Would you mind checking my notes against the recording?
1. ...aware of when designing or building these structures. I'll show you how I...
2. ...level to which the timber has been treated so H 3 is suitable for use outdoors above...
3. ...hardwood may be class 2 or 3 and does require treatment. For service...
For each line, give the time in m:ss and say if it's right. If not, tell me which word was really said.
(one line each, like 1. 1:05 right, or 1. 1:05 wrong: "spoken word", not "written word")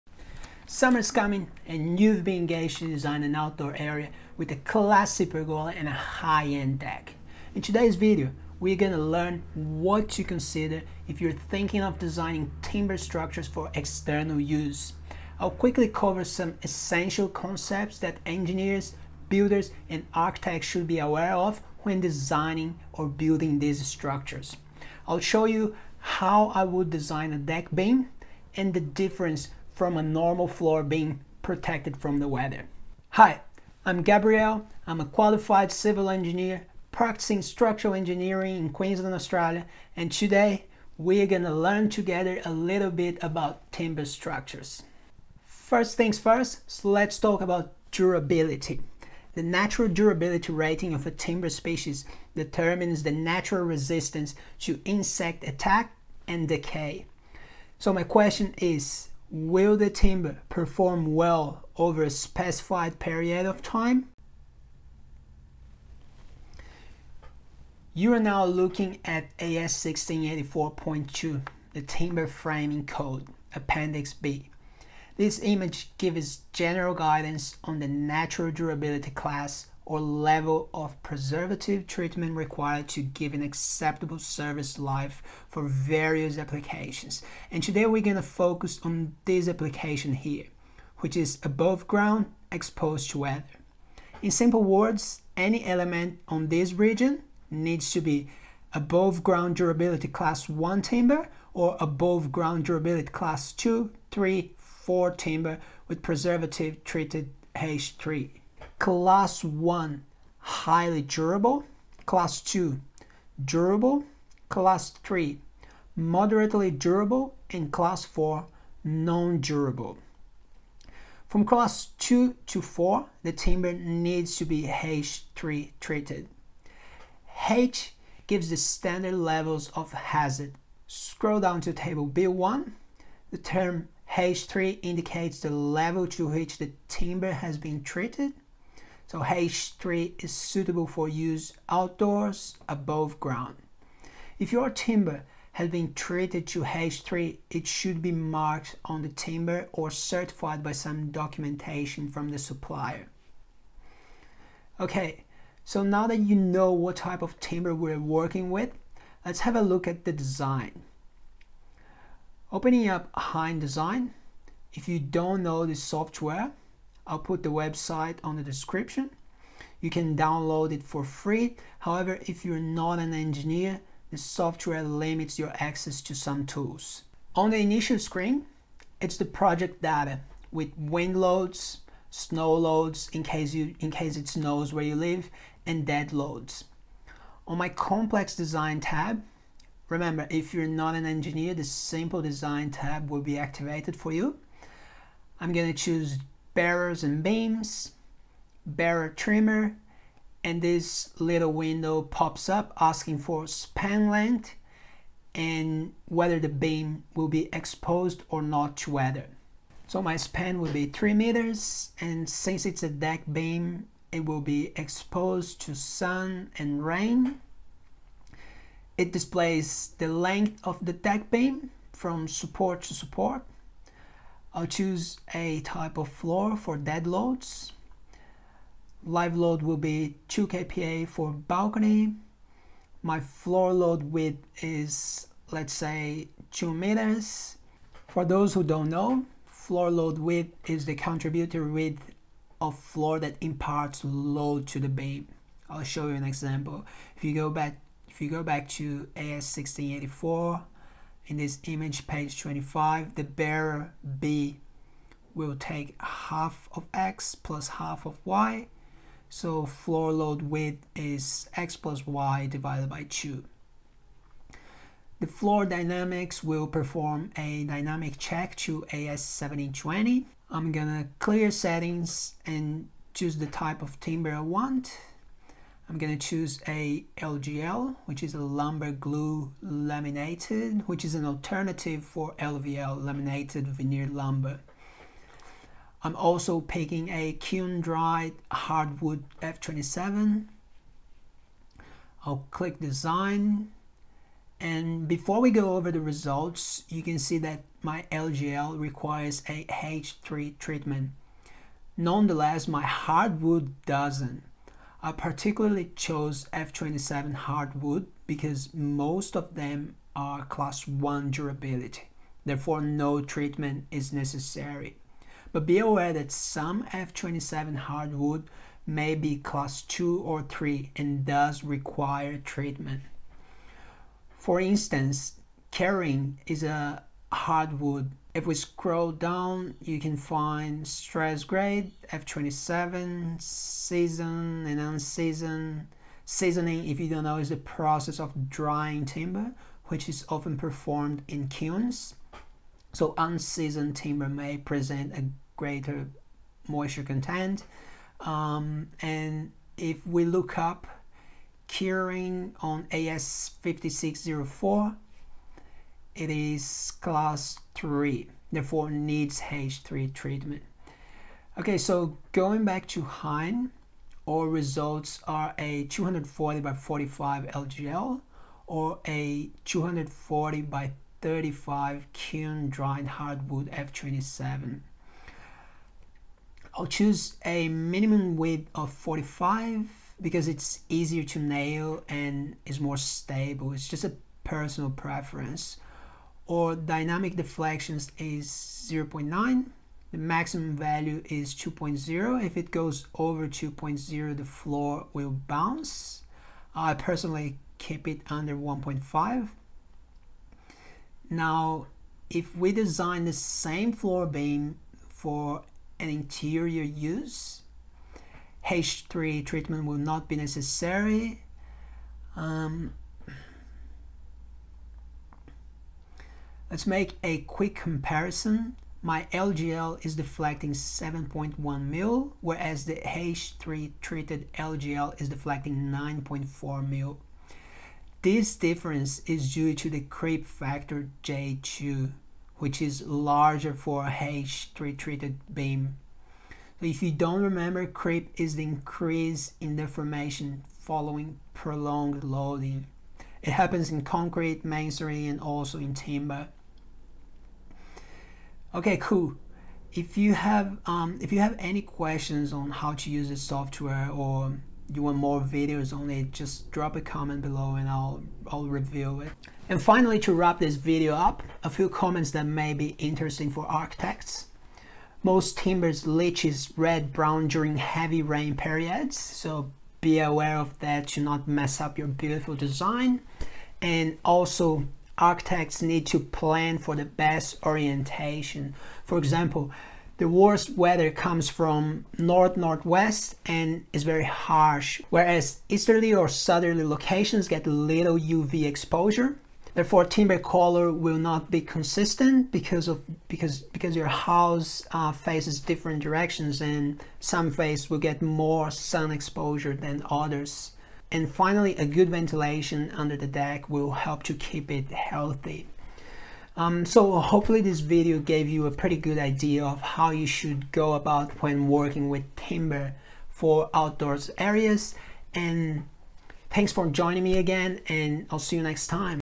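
1. 0:20 right
2. 2:15 right
3. 5:17 wrong: "instance", not "service".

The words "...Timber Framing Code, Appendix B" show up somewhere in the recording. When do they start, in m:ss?
1:11.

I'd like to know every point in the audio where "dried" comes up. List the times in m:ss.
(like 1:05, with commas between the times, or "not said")
4:47, 6:12.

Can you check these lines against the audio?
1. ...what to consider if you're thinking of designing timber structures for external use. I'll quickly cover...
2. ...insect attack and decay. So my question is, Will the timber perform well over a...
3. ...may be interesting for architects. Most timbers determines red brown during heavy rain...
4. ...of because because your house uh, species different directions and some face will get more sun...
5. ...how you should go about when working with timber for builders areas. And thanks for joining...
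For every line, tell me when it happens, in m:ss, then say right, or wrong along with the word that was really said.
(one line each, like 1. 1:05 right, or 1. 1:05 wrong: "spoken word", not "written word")
1. 0:09 right
2. 0:54 right
3. 7:42 wrong: "leaches", not "determines"
4. 8:12 wrong: "faces", not "species"
5. 8:29 wrong: "outdoors", not "builders".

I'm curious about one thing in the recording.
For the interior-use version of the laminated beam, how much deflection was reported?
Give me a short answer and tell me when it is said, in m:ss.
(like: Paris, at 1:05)
7.1 mm, at 7:00.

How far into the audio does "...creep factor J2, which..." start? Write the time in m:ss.
7:09.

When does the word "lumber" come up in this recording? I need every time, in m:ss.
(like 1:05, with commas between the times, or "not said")
4:38, 4:44.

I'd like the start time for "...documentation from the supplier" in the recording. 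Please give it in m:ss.
2:31.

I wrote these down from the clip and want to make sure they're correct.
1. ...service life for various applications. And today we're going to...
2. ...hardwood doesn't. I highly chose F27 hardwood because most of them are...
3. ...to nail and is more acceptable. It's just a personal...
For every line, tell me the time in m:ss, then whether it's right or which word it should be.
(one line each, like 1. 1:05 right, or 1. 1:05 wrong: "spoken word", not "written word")
1. 1:24 right
2. 5:02 wrong: "particularly", not "highly"
3. 6:21 wrong: "stable", not "acceptable".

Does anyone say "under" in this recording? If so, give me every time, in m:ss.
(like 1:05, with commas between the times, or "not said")
6:38, 8:22.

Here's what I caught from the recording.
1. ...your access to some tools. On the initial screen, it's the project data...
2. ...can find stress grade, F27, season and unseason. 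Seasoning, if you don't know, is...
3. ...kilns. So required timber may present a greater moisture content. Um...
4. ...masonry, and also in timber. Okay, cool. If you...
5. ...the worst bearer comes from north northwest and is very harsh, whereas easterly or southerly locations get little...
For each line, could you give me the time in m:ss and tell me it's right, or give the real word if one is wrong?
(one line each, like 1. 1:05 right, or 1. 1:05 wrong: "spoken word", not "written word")
1. 2:55 right
2. 5:29 right
3. 5:41 wrong: "unseasoned", not "required"
4. 7:24 right
5. 8:00 wrong: "weather", not "bearer".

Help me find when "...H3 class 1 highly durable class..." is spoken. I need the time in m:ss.
1:47.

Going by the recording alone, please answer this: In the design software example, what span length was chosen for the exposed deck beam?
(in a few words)
3 meters.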